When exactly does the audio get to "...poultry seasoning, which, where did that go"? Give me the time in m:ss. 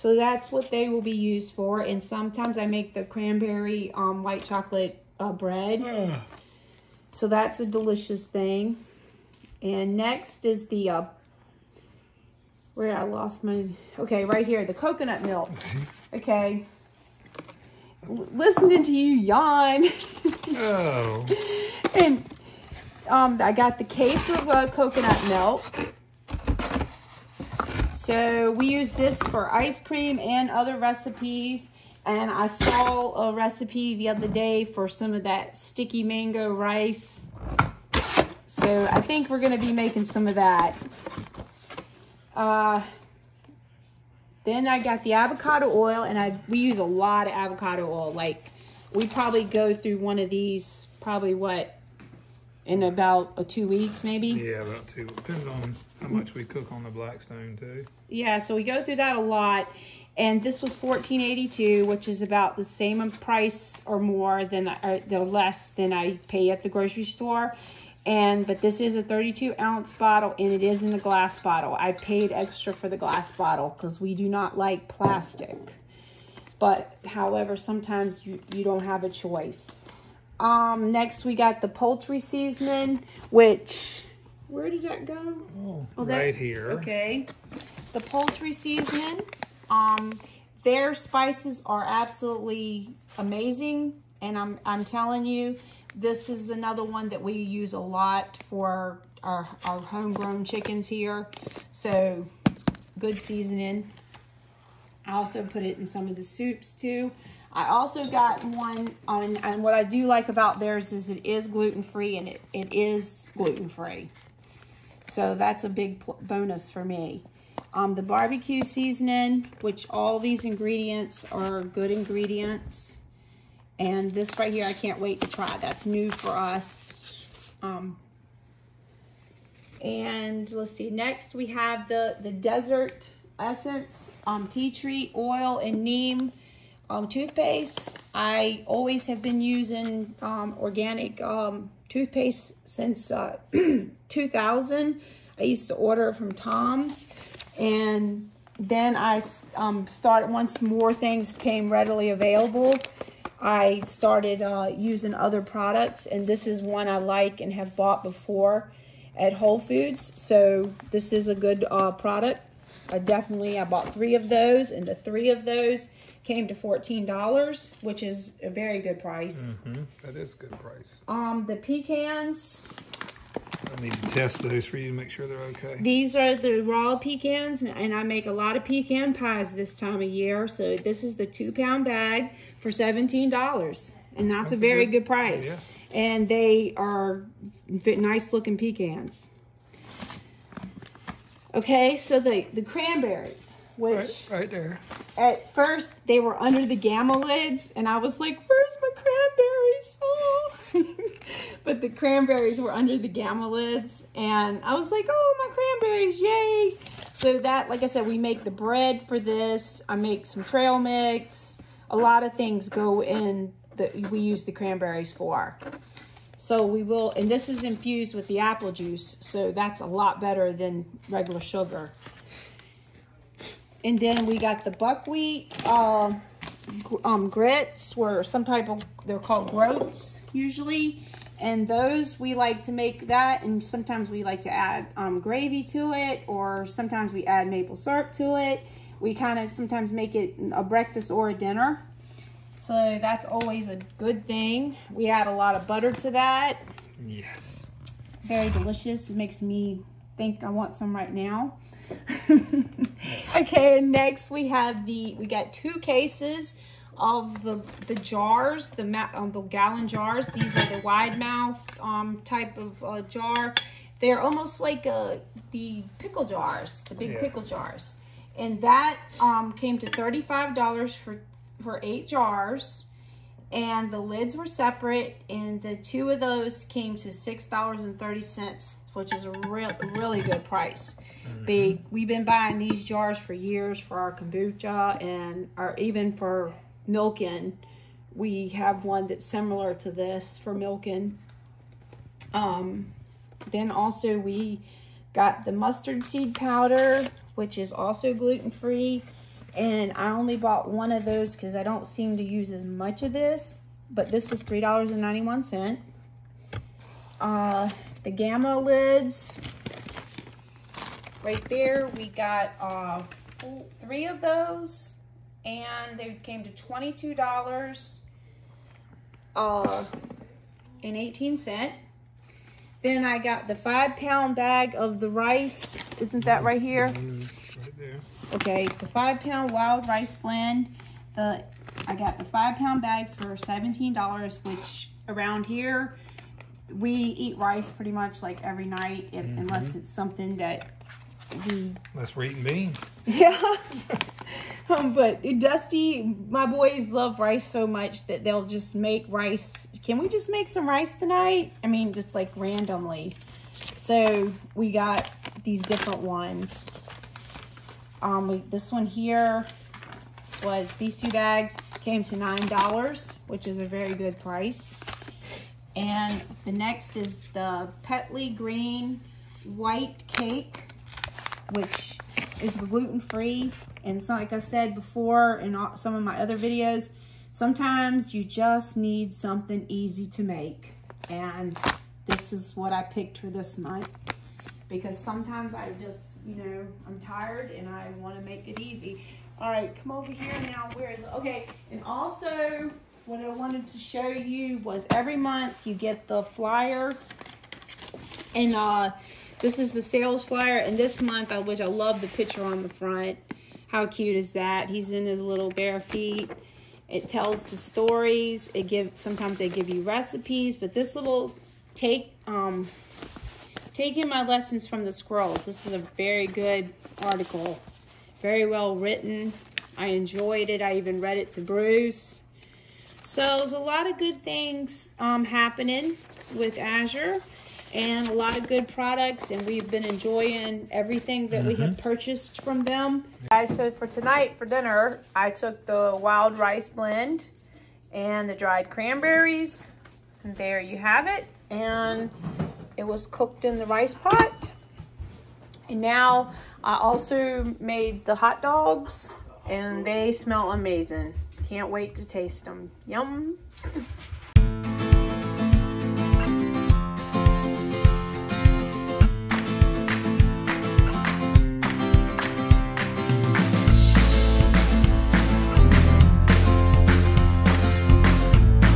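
1:21.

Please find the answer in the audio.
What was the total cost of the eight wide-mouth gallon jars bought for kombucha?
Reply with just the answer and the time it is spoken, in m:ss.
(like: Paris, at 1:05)
$35, at 4:29.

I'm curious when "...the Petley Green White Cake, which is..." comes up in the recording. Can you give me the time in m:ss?
6:07.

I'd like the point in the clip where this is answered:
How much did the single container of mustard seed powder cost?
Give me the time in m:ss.
5:04.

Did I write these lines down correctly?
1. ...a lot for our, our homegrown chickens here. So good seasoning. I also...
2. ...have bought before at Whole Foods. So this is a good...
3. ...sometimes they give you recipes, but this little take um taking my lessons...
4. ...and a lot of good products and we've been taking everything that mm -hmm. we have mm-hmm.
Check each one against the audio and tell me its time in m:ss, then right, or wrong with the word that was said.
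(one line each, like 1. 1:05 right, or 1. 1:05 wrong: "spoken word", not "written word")
1. 1:37 right
2. 2:37 right
3. 6:48 right
4. 7:07 wrong: "enjoying", not "taking".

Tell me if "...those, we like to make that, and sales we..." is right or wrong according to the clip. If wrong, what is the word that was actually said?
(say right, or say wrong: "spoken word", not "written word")
wrong: "sometimes", not "sales".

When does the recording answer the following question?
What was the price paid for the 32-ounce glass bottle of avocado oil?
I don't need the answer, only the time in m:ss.
1:00.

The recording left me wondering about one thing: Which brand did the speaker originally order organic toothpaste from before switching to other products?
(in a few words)
Tom's.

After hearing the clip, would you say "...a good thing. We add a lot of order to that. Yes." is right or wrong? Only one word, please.
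wrong.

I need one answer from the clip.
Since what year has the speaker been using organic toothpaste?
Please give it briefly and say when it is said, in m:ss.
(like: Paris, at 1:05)
2000, at 2:24.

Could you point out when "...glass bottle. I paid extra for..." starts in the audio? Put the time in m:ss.
1:10.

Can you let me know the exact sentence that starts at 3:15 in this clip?
At first, they were under the gamma lids, and I was like, where's my cranberries?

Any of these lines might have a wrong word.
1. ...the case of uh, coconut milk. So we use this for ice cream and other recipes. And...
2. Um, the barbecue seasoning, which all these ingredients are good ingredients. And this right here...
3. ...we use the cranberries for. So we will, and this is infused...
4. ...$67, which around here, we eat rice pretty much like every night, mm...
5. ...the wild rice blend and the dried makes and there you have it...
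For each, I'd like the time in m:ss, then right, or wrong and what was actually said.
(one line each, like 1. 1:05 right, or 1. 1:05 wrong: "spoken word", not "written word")
1. 0:23 right
2. 1:57 right
3. 3:34 right
4. 5:33 wrong: "17", not "67"
5. 7:15 wrong: "cranberries", not "makes".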